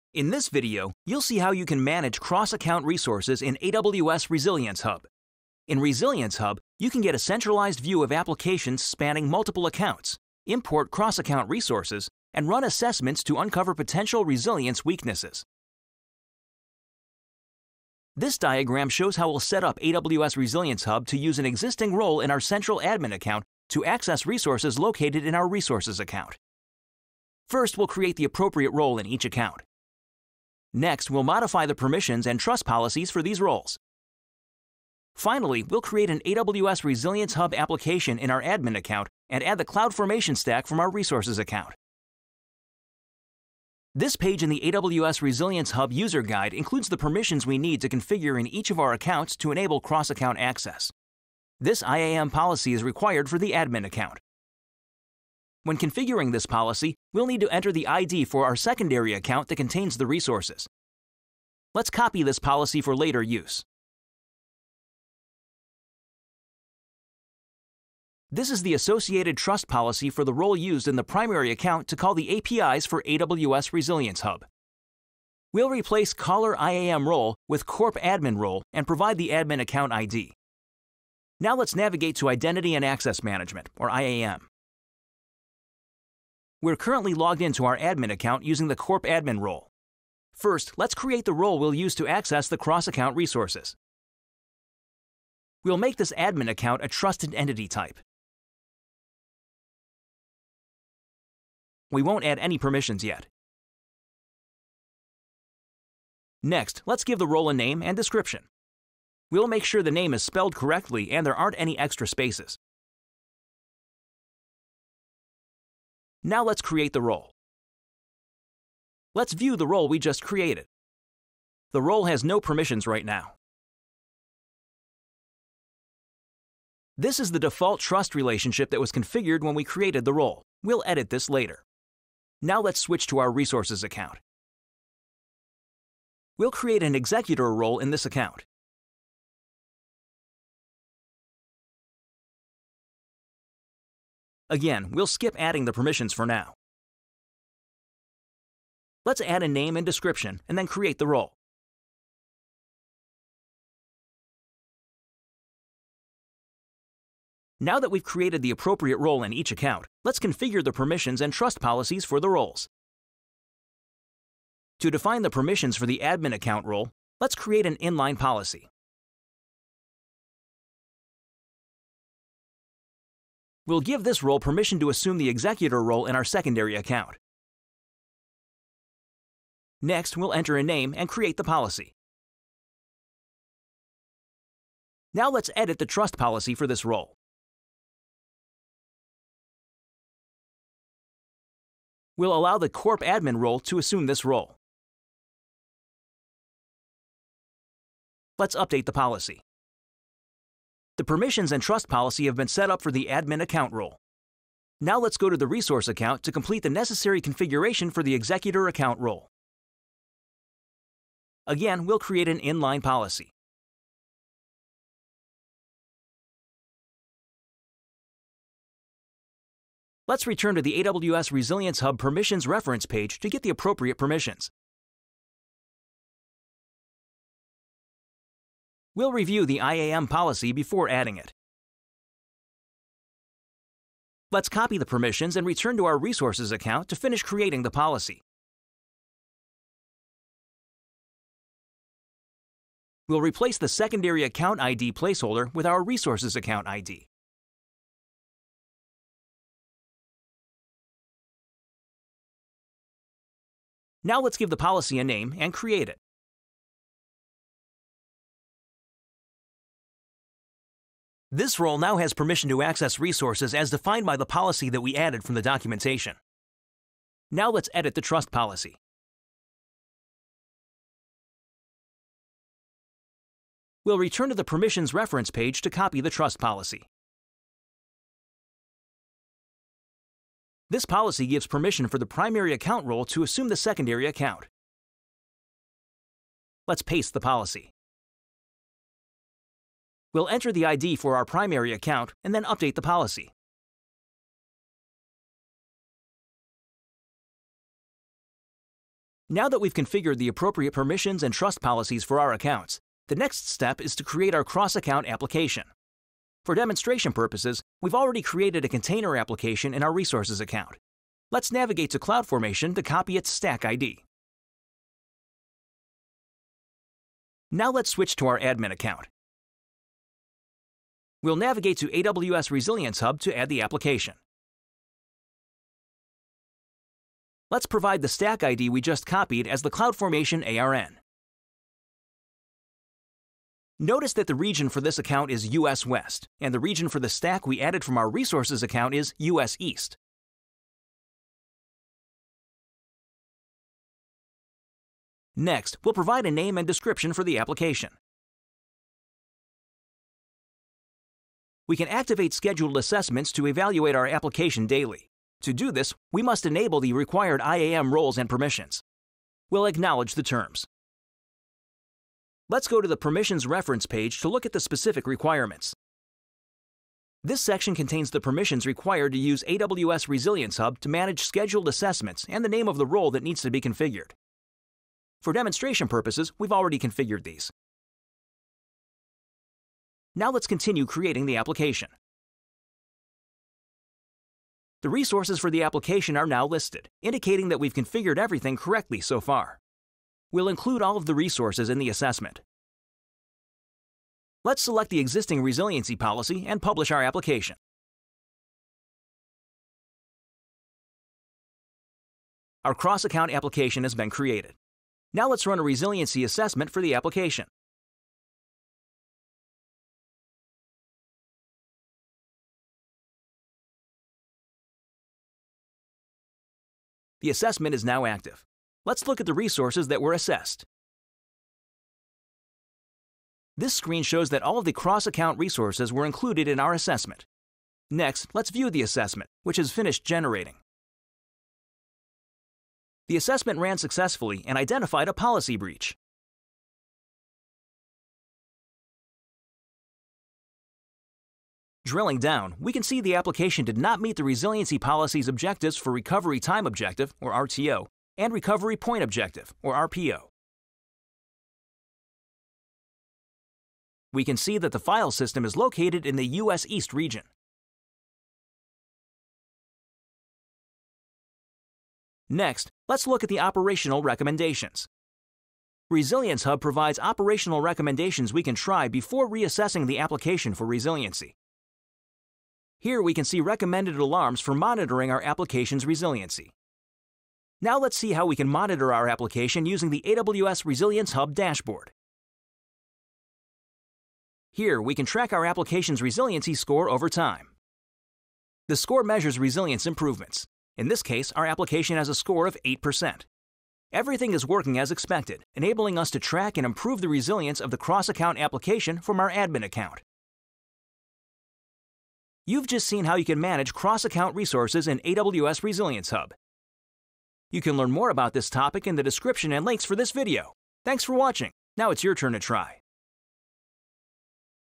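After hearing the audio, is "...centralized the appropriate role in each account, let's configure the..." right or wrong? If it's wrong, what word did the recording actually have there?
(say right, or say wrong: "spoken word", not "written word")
wrong: "created", not "centralized".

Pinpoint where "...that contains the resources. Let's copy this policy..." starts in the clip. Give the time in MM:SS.
00:59.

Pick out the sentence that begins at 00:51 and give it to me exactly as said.
This IAM policy is required for the admin account.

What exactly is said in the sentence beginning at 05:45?
Next, we'll provide a name and description for the application.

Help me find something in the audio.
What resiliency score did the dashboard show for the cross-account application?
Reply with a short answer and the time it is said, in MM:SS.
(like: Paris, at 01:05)
8%, at 08:12.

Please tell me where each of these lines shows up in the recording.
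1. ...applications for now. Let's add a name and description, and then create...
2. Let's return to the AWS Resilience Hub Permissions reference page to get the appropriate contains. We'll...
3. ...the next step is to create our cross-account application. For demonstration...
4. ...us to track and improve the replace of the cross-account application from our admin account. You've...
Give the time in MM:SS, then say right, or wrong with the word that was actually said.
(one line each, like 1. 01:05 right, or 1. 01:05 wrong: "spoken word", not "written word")
1. 02:25 wrong: "permissions", not "applications"
2. 03:40 wrong: "permissions", not "contains"
3. 05:03 right
4. 08:15 wrong: "resilience", not "replace".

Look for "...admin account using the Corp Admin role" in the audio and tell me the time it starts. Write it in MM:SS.
01:27.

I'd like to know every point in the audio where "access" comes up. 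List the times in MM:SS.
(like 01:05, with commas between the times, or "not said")
00:23, 00:50, 01:22, 01:32, 04:22.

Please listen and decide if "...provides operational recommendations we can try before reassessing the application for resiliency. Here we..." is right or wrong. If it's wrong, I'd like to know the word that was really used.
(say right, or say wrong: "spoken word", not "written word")
right.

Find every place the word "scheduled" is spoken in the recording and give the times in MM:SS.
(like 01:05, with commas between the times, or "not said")
05:52, 06:11.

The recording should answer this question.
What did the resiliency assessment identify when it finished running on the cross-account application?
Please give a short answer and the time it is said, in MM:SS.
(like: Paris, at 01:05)
A policy breach, at 07:15.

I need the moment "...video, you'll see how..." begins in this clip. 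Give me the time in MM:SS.
00:00.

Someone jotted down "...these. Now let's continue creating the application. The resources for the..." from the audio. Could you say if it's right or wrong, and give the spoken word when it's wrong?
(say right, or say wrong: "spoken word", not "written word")
right.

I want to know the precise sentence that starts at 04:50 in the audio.
We'll enter the ID for our primary account and then update the policy.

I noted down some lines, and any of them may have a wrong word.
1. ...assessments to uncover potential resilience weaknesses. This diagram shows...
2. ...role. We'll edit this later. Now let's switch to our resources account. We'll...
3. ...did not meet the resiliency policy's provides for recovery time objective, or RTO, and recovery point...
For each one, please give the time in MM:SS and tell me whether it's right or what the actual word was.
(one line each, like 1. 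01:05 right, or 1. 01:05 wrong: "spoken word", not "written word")
1. 00:12 right
2. 02:10 right
3. 07:23 wrong: "objectives", not "provides".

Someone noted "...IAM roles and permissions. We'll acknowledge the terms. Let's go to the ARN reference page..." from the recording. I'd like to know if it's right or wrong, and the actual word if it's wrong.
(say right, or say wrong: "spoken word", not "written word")
wrong: "Permissions", not "ARN".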